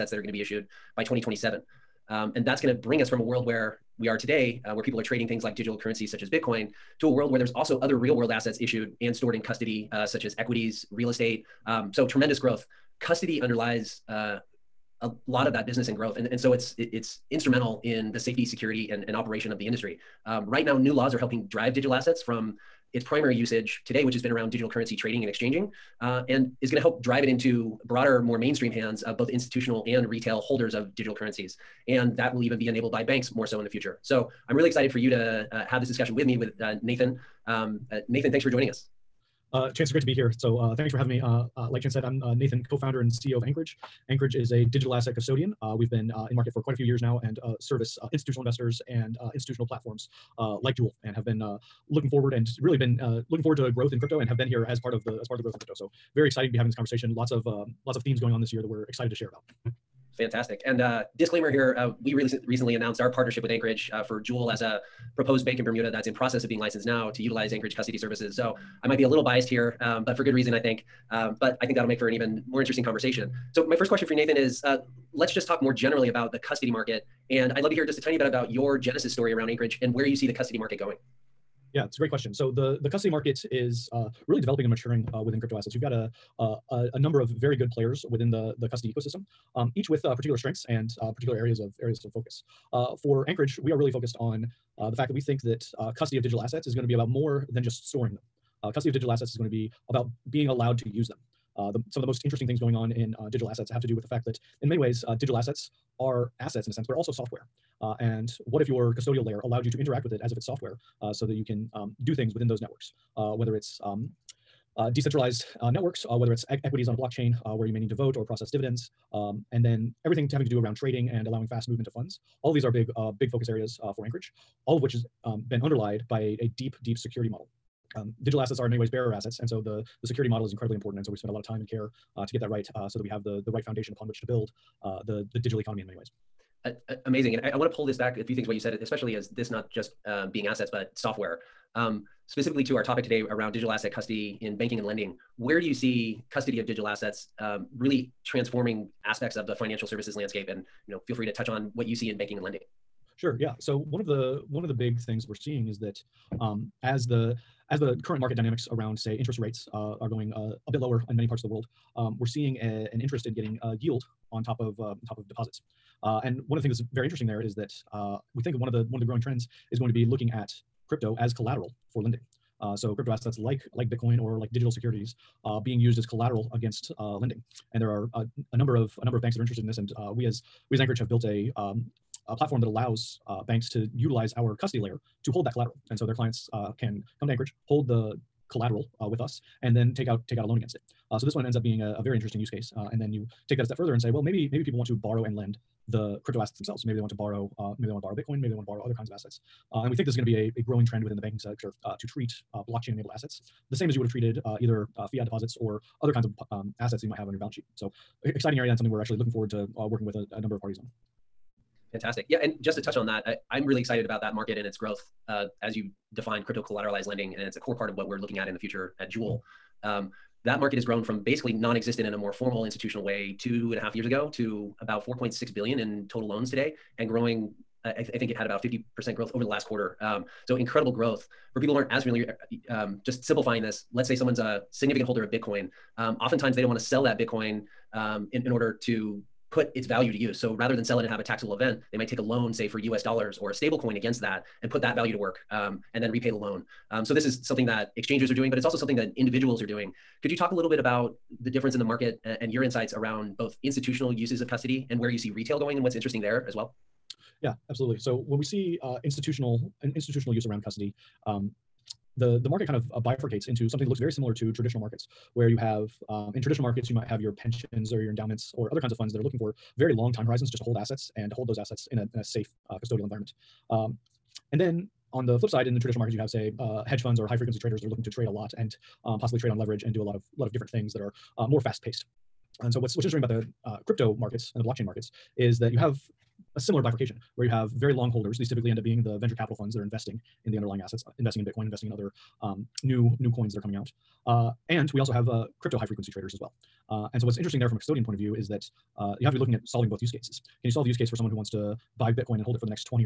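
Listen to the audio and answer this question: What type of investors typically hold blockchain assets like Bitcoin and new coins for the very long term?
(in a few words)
venture capital funds.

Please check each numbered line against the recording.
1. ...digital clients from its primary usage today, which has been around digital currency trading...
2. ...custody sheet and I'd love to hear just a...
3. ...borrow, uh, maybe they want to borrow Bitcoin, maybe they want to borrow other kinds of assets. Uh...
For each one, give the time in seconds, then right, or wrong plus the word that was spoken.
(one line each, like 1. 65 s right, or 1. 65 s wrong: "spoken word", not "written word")
1. 21 s wrong: "assets", not "clients"
2. 76 s wrong: "market", not "sheet"
3. 197 s right.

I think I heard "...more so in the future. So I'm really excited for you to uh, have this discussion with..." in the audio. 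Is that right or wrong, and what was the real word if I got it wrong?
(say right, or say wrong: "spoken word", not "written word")
right.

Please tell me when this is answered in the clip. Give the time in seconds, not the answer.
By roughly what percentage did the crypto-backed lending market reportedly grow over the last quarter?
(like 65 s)
228 s.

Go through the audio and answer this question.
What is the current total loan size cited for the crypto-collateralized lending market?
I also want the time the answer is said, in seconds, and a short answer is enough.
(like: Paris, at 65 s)
4.6 billion, at 225 s.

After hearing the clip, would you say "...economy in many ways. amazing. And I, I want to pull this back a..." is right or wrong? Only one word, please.
right.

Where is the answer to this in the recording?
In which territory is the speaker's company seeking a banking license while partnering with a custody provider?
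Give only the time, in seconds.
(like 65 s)
65 s.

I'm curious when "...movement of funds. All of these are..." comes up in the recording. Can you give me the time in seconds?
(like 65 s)
121 s.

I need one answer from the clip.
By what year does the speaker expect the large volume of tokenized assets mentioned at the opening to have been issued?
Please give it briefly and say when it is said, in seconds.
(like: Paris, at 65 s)
2027, at 1 s.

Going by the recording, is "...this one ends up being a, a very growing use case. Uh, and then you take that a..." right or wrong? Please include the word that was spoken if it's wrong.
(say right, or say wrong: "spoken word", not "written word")
wrong: "interesting", not "growing".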